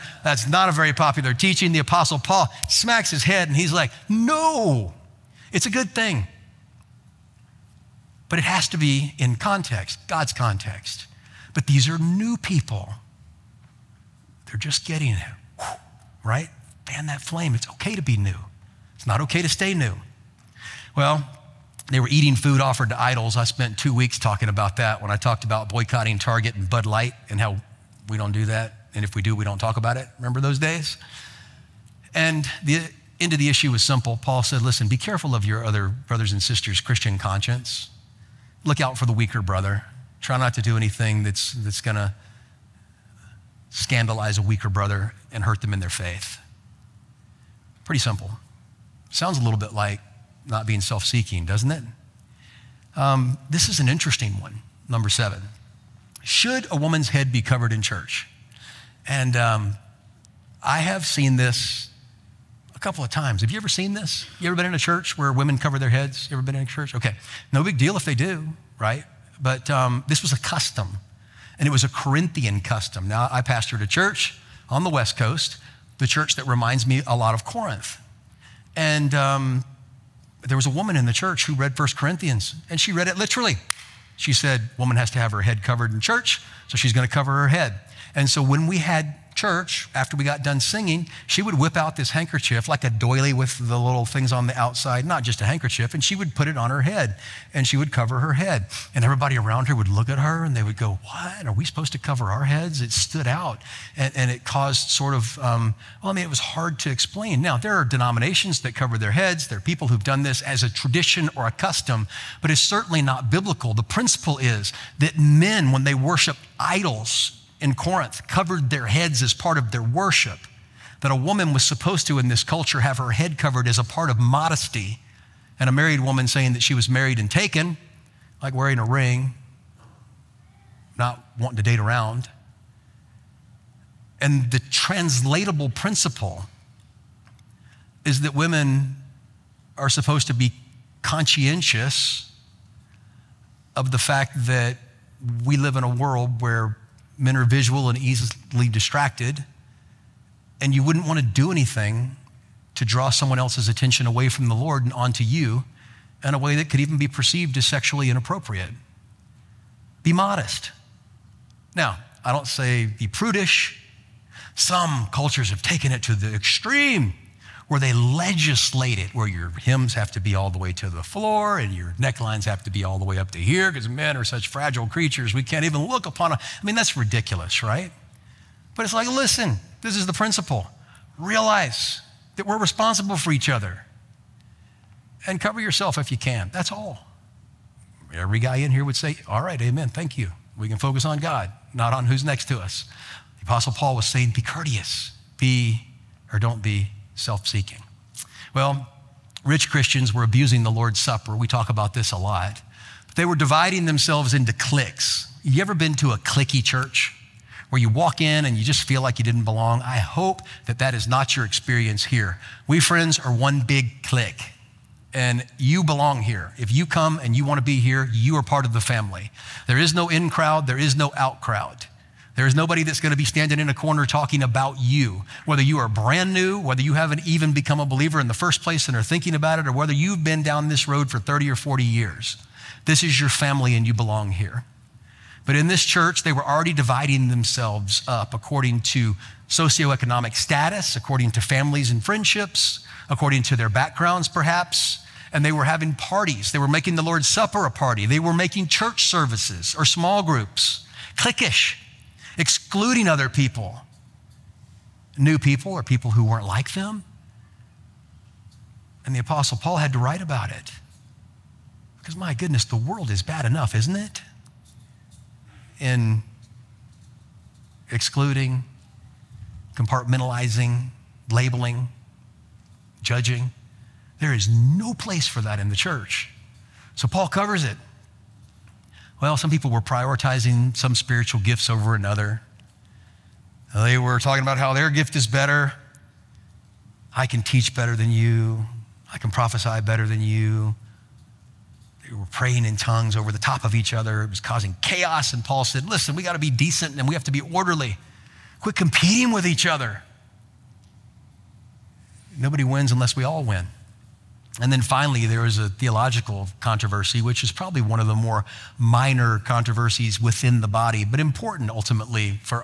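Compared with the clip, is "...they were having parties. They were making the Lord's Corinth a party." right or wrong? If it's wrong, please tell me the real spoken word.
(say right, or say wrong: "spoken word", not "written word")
wrong: "Supper", not "Corinth".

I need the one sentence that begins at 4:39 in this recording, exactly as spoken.
Well, some people were prioritizing some spiritual gifts over another.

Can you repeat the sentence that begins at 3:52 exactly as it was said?
This is your family and you belong here.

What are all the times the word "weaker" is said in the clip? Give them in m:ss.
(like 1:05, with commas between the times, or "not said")
0:39, 0:44.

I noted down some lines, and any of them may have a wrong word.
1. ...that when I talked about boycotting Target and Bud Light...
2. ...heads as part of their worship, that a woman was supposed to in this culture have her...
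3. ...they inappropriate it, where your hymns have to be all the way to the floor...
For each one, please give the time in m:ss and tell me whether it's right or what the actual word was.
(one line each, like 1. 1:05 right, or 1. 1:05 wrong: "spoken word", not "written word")
1. 0:24 right
2. 1:58 right
3. 2:47 wrong: "legislate", not "inappropriate".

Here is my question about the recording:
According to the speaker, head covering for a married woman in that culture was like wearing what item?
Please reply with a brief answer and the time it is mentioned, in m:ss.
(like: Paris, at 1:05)
a ring, at 2:08.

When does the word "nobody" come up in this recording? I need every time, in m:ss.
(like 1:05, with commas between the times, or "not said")
3:42, 5:02.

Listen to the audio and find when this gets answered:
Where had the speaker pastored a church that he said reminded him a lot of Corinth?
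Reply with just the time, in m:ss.
1:14.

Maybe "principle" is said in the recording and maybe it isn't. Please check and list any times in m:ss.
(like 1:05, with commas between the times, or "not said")
1:53, 2:15, 3:00.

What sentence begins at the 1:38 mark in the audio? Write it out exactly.
And everybody around her would look at her and they would go, What?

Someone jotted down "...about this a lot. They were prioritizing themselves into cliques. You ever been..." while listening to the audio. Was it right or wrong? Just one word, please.
wrong.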